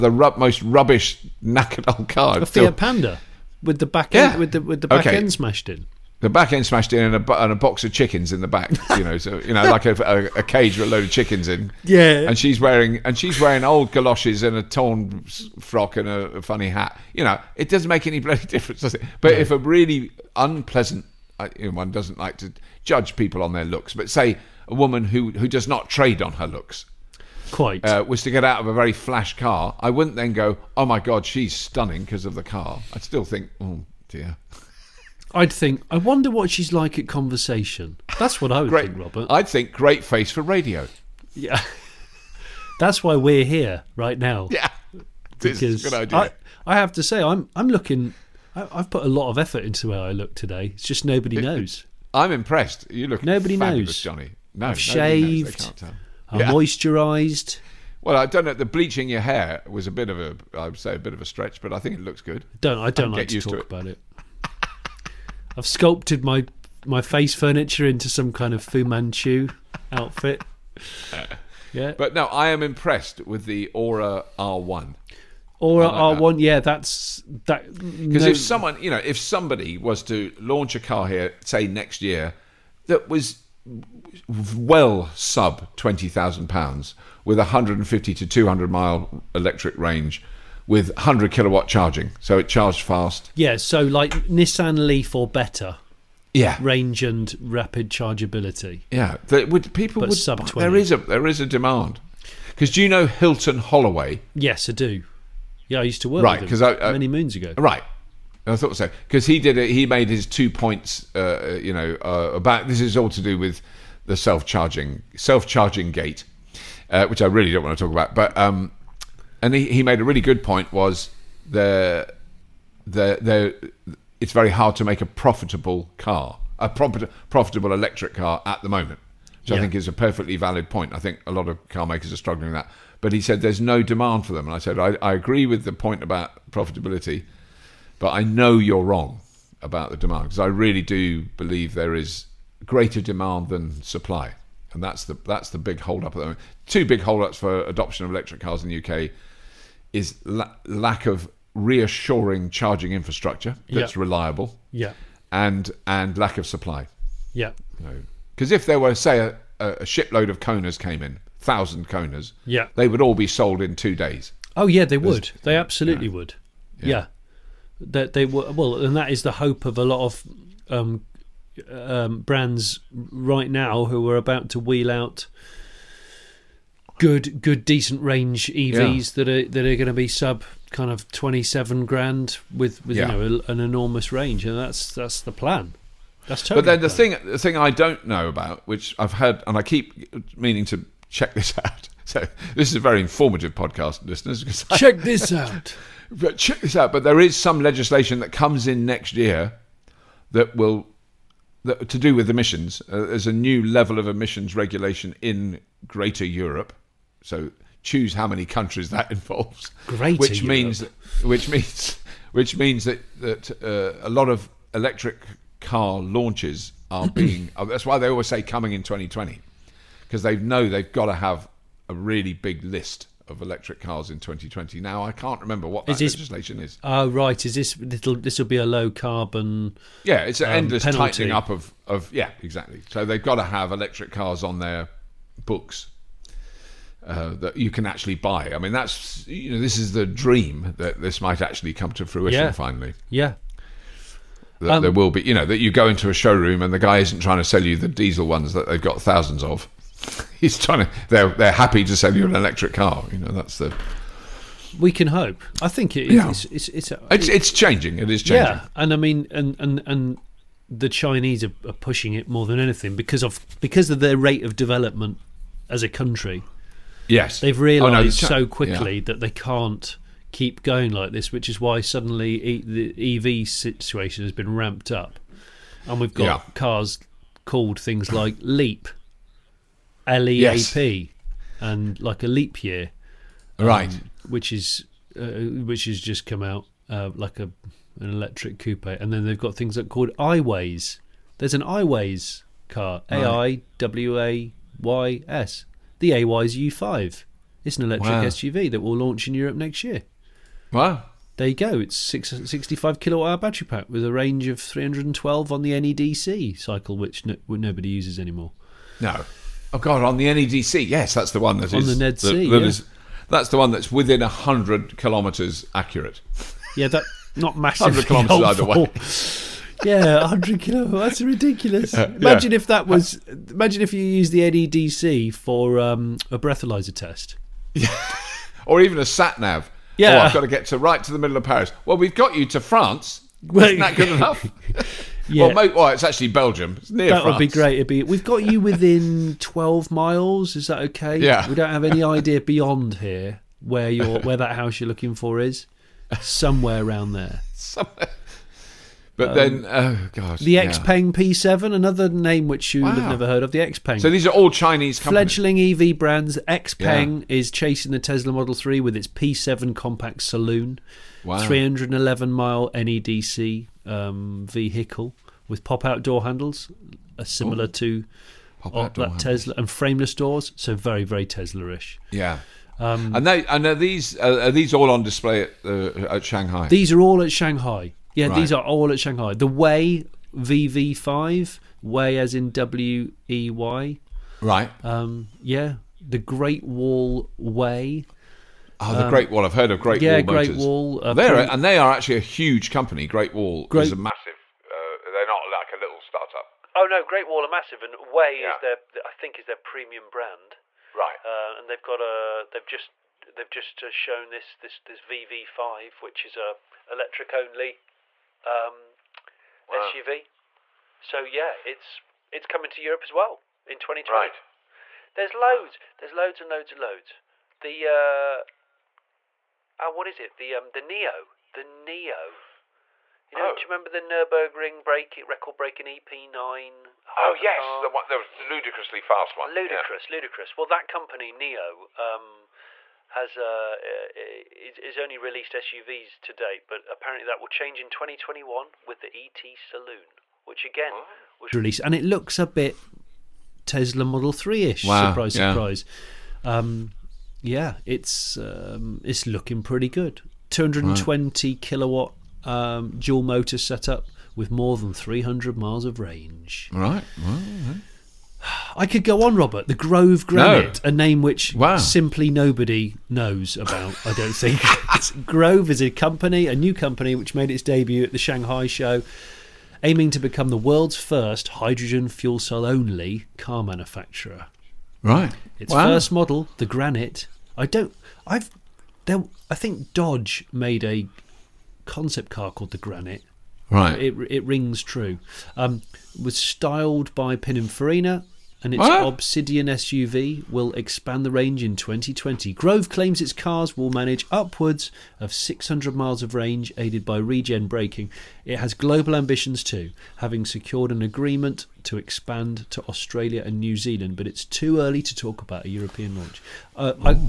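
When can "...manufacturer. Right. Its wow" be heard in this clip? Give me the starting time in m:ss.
7:53.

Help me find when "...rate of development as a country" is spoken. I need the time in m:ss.
4:24.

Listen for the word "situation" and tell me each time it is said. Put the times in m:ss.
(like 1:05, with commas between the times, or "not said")
4:33.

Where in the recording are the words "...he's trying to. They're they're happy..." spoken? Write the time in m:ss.
4:10.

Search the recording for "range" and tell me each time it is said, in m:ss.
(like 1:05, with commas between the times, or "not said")
1:29, 1:36, 2:58, 3:04, 5:04, 7:35, 8:11, 8:16.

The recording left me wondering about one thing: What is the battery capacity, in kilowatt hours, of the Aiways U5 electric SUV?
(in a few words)
65.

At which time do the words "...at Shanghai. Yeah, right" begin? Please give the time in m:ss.
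6:17.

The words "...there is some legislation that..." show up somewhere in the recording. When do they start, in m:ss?
3:17.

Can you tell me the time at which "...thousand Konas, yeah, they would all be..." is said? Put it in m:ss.
2:41.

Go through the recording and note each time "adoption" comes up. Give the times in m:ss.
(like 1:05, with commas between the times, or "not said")
2:27.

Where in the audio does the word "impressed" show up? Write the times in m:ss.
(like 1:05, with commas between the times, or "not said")
0:52, 1:12.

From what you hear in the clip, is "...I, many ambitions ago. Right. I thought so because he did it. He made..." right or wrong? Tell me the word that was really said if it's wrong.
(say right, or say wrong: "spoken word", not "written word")
wrong: "moons", not "ambitions".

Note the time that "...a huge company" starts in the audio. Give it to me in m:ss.
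6:32.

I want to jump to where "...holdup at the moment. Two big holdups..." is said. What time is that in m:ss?
2:25.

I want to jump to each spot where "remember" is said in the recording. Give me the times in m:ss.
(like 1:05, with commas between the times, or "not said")
3:45, 7:03.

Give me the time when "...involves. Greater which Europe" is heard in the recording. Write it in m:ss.
3:29.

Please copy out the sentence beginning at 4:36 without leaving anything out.
cars called things like Leap, L E A P, yes.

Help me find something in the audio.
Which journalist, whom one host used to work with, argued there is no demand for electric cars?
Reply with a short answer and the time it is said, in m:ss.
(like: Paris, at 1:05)
Hilton Holloway, at 1:43.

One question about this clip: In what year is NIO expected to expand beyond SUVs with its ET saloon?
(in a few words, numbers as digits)
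2021.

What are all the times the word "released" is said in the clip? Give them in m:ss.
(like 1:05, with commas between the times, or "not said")
7:15, 7:21.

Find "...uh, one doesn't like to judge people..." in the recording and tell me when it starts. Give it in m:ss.
0:21.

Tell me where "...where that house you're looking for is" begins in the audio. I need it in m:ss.
5:44.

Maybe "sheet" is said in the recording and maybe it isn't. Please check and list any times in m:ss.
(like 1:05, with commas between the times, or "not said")
not said.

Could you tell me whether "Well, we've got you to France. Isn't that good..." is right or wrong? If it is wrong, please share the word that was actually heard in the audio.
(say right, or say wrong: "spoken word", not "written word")
right.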